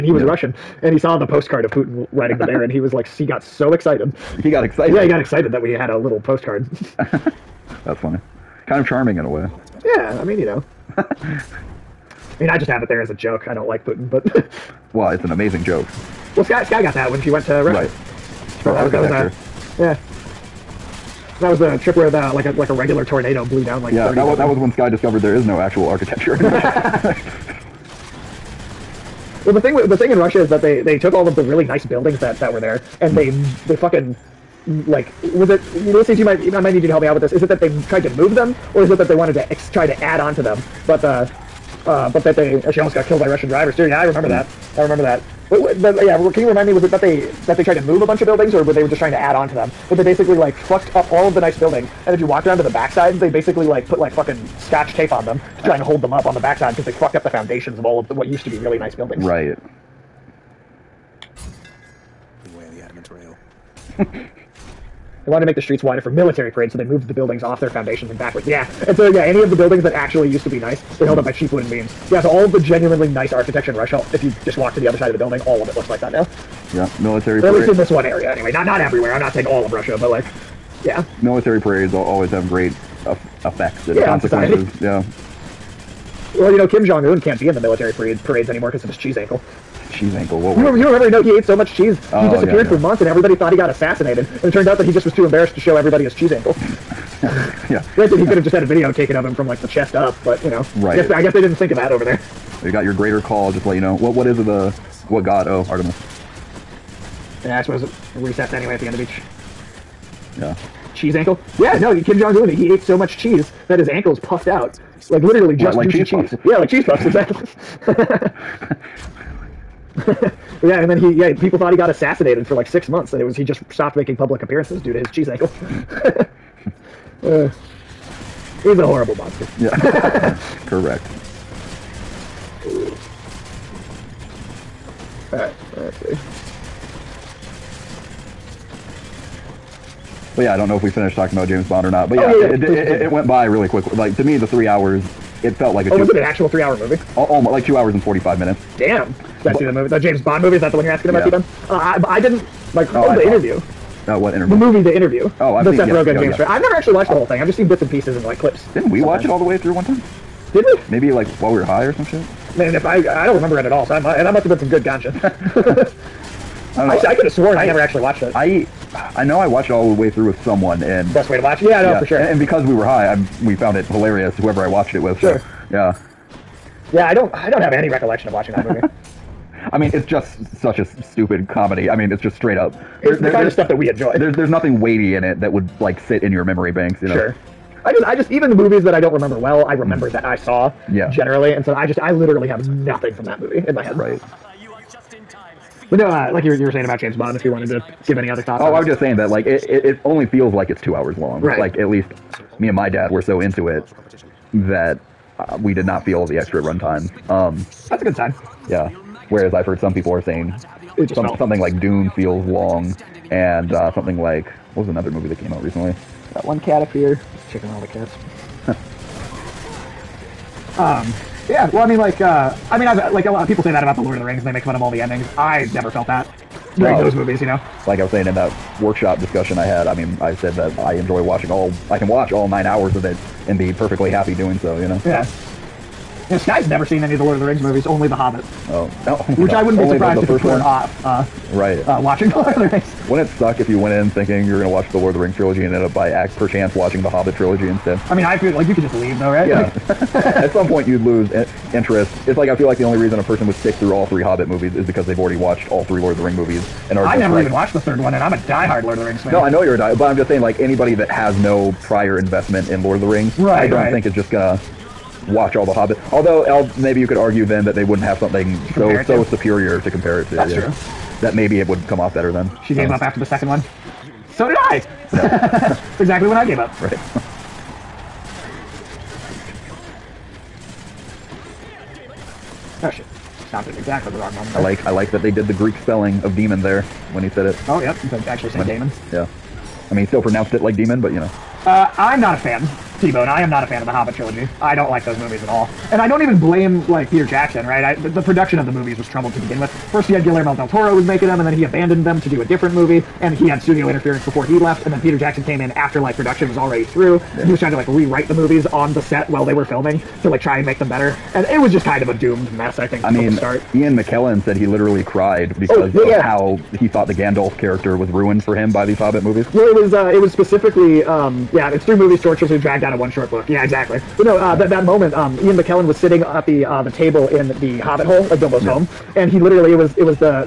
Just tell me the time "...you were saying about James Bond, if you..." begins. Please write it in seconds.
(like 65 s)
196 s.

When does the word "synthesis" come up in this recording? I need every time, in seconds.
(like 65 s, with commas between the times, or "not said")
not said.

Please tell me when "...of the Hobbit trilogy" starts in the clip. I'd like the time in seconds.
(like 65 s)
293 s.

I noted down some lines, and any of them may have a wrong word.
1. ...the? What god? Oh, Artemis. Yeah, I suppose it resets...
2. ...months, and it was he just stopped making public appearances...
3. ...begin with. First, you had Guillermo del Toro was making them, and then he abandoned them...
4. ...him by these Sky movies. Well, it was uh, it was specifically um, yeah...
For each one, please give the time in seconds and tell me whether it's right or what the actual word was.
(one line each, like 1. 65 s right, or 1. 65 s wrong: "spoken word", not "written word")
1. 104 s right
2. 122 s right
3. 299 s right
4. 318 s wrong: "Hobbit", not "Sky".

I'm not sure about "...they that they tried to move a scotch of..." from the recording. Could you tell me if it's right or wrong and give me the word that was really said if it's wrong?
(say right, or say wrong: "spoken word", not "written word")
wrong: "bunch", not "scotch".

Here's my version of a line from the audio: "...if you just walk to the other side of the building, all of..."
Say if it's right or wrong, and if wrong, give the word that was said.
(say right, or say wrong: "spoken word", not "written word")
right.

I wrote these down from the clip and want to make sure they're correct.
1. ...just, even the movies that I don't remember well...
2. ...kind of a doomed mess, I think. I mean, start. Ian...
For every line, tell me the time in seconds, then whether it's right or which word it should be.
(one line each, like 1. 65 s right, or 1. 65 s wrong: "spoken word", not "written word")
1. 188 s right
2. 311 s right.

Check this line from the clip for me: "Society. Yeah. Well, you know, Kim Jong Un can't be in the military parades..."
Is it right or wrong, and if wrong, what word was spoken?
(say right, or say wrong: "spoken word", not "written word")
right.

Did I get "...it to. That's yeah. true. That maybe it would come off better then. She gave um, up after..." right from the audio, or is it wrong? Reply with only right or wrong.
right.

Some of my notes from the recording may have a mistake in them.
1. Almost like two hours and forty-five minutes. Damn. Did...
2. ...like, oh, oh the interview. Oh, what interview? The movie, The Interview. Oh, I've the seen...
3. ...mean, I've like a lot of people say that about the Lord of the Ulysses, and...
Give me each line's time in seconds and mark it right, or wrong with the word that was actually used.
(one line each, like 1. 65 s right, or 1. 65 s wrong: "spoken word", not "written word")
1. 147 s right
2. 152 s right
3. 222 s wrong: "Rings", not "Ulysses".